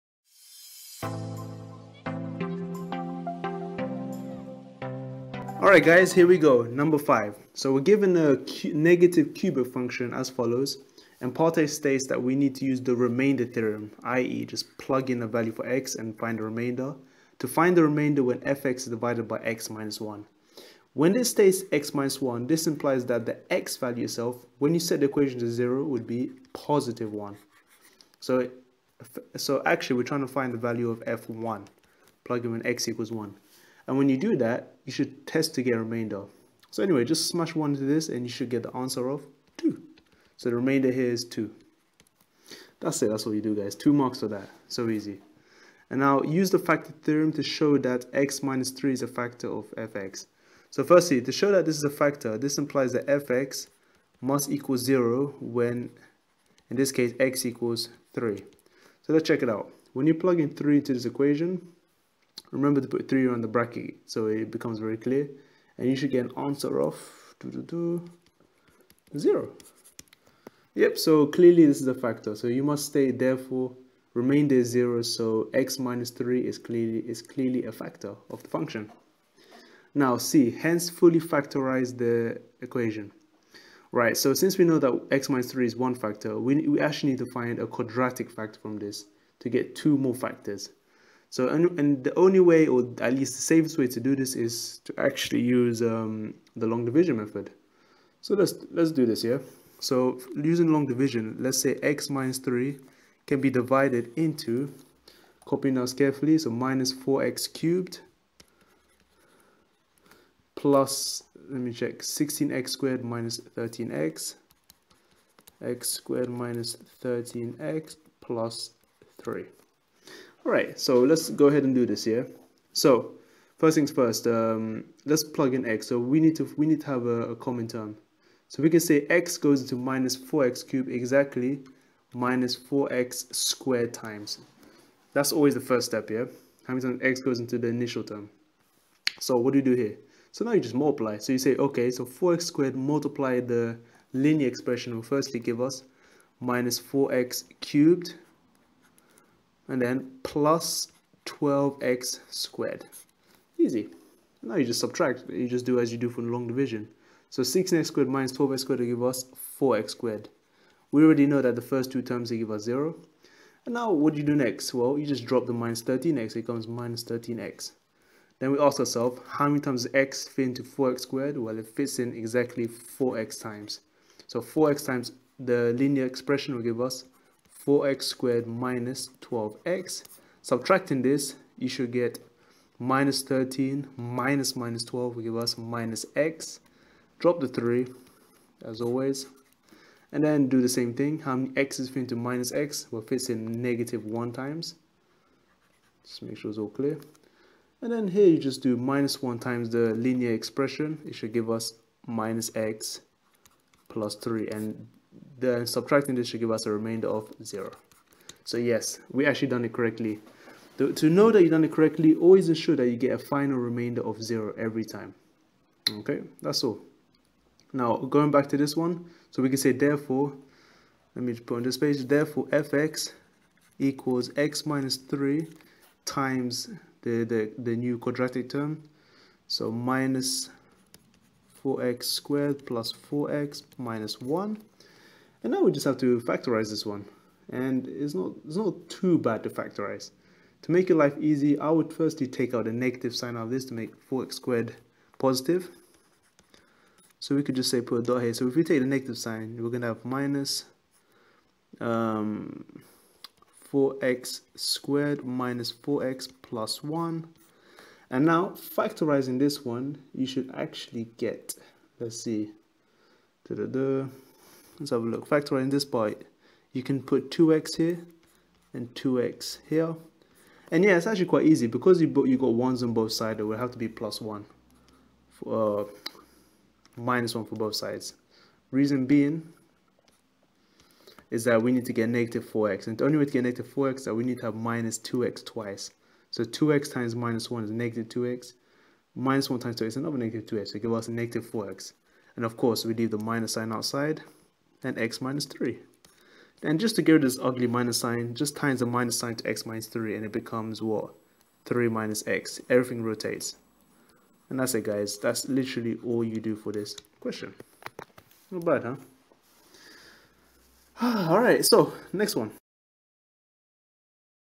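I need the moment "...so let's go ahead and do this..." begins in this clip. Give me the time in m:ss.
2:00.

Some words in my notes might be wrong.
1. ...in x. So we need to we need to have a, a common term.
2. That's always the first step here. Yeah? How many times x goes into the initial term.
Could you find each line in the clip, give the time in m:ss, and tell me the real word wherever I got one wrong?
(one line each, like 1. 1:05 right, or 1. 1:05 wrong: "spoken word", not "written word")
1. 2:05 right
2. 2:15 right.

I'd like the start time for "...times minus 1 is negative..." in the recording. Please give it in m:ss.
4:46.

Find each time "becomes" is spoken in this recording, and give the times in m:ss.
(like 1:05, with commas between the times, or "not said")
1:04, 2:46, 5:00.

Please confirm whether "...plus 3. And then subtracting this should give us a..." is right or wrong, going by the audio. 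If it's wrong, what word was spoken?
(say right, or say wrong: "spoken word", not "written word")
right.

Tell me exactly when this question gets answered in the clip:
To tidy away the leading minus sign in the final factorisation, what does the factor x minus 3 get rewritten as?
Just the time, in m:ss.
5:01.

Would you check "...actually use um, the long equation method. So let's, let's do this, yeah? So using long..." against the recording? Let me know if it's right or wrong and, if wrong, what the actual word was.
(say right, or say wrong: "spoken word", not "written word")
wrong: "division", not "equation".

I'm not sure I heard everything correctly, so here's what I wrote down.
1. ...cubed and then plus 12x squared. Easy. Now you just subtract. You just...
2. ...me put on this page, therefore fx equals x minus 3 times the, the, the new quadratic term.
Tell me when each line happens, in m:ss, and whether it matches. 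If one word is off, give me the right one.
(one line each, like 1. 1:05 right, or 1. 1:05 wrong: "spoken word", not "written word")
1. 2:27 right
2. 3:41 right.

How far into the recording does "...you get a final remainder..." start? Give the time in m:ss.
3:32.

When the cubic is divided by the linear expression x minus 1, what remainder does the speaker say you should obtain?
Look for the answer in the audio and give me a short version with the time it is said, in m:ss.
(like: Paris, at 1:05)
2, at 0:38.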